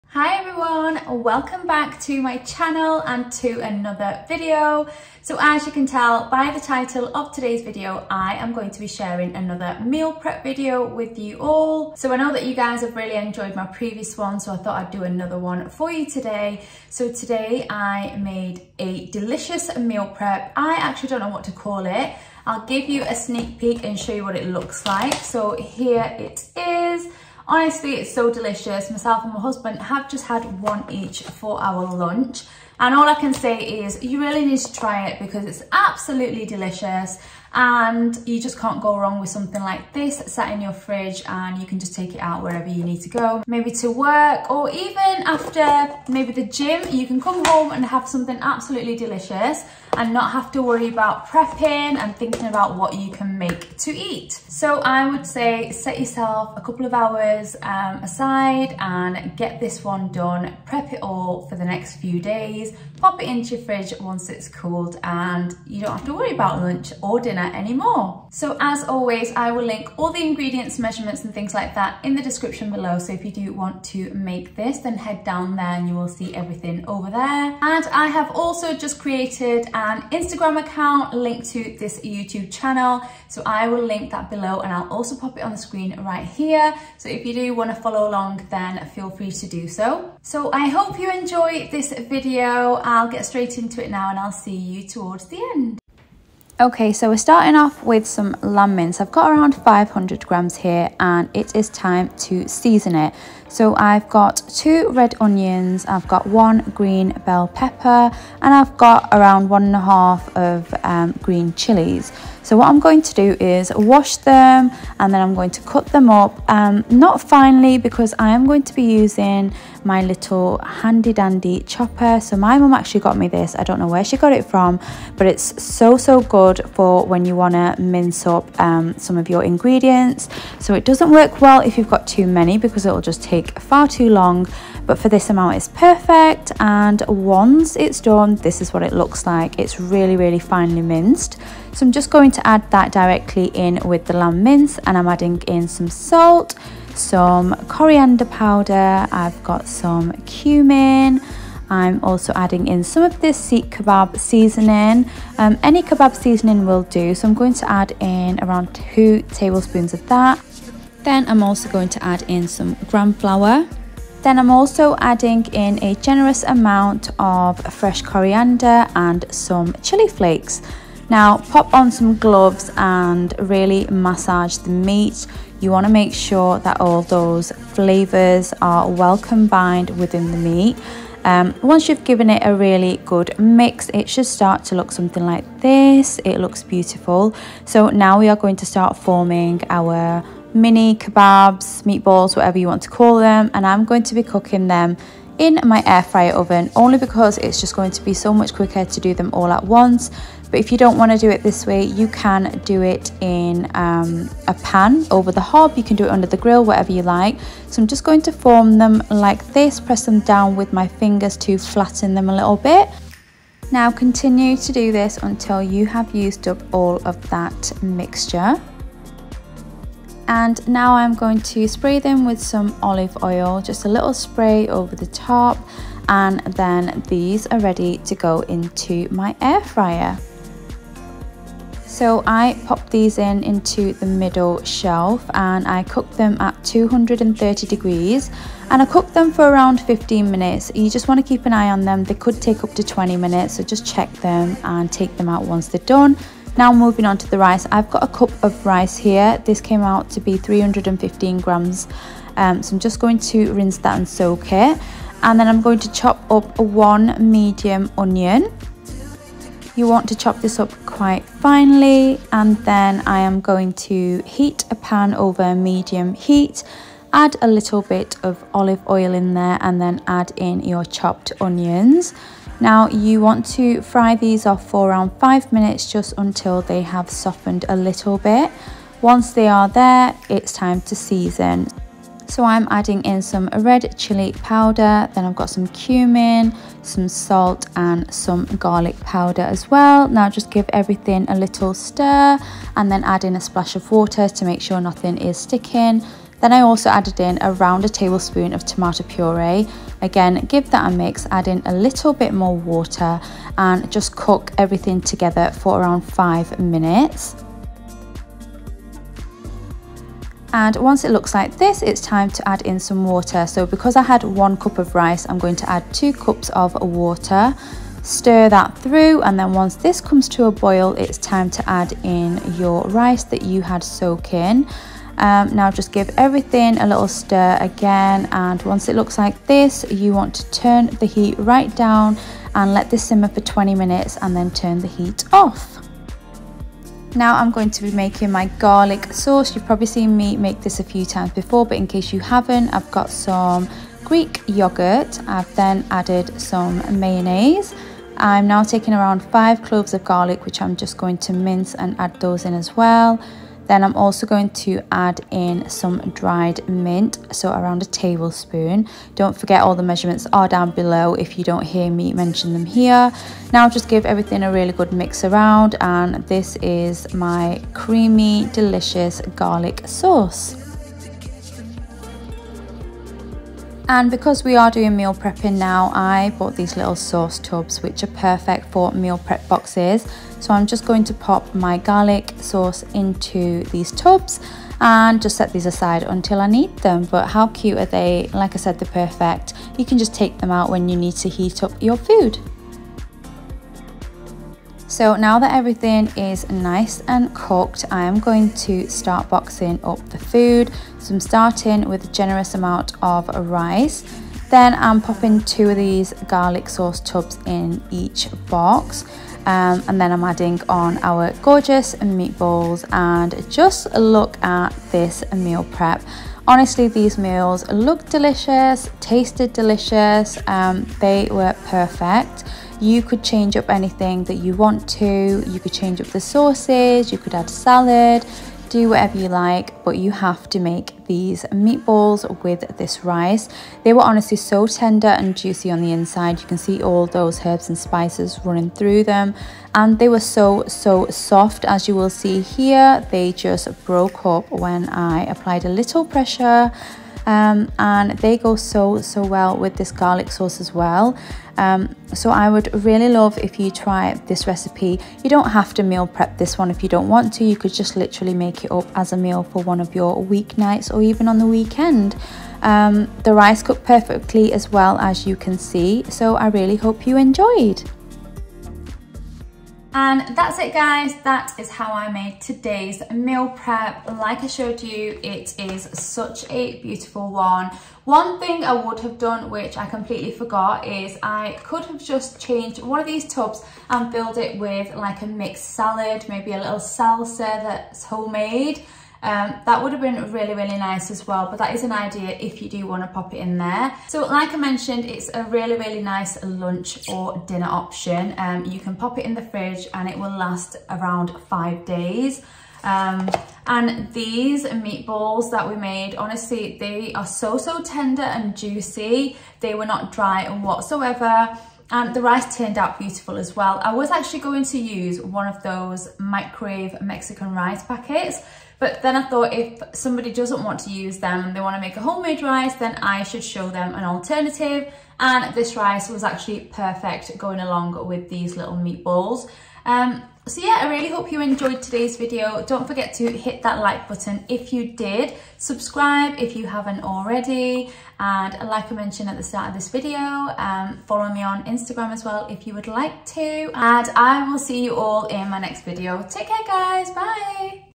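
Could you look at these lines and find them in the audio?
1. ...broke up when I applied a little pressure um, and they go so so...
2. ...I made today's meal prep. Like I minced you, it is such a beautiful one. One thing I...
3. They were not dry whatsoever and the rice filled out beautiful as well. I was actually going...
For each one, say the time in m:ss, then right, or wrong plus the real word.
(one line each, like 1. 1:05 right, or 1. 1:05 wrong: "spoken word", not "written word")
1. 7:23 right
2. 7:51 wrong: "showed", not "minced"
3. 8:29 wrong: "turned", not "filled".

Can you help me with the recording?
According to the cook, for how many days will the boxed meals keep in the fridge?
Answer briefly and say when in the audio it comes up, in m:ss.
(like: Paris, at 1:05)
5 days, at 8:21.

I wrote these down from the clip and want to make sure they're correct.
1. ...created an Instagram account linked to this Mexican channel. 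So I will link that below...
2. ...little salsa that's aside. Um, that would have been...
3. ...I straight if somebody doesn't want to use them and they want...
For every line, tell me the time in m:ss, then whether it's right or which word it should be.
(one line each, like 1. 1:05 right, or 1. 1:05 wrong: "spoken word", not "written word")
1. 1:18 wrong: "YouTube", not "Mexican"
2. 8:06 wrong: "homemade", not "aside"
3. 8:39 wrong: "thought", not "straight".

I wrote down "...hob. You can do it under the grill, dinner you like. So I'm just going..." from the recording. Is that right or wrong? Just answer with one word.
wrong.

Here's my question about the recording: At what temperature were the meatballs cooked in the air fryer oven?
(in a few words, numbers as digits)
230 degrees.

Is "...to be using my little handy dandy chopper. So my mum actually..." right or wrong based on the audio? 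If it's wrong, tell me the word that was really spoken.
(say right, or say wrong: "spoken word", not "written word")
right.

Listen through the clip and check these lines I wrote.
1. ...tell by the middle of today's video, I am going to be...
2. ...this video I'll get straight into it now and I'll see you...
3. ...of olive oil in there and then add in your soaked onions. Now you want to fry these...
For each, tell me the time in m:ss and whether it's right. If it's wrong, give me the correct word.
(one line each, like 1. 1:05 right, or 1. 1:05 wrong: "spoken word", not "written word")
1. 0:05 wrong: "title", not "middle"
2. 1:31 right
3. 4:28 wrong: "chopped", not "soaked".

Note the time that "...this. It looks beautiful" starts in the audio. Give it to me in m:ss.
3:05.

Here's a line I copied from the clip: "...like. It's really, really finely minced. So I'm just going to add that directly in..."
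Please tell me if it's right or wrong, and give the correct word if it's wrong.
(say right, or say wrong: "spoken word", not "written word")
right.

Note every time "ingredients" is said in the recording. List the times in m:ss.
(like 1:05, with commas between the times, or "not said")
1:10, 2:09.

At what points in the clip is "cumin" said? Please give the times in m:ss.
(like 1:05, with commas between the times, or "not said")
2:30, 4:45.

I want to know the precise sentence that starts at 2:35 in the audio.
Um, any kebab seasoning will do.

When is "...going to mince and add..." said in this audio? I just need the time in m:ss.
5:50.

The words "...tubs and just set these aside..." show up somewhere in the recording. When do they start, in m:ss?
6:23.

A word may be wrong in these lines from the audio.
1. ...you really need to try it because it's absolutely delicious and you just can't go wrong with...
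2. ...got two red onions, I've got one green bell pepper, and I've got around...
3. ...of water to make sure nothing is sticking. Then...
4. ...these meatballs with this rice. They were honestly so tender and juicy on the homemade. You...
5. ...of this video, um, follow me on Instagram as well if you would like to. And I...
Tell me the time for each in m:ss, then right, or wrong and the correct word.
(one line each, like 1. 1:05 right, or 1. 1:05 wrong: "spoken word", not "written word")
1. 0:34 right
2. 1:44 right
3. 4:53 right
4. 7:11 wrong: "inside", not "homemade"
5. 8:59 right.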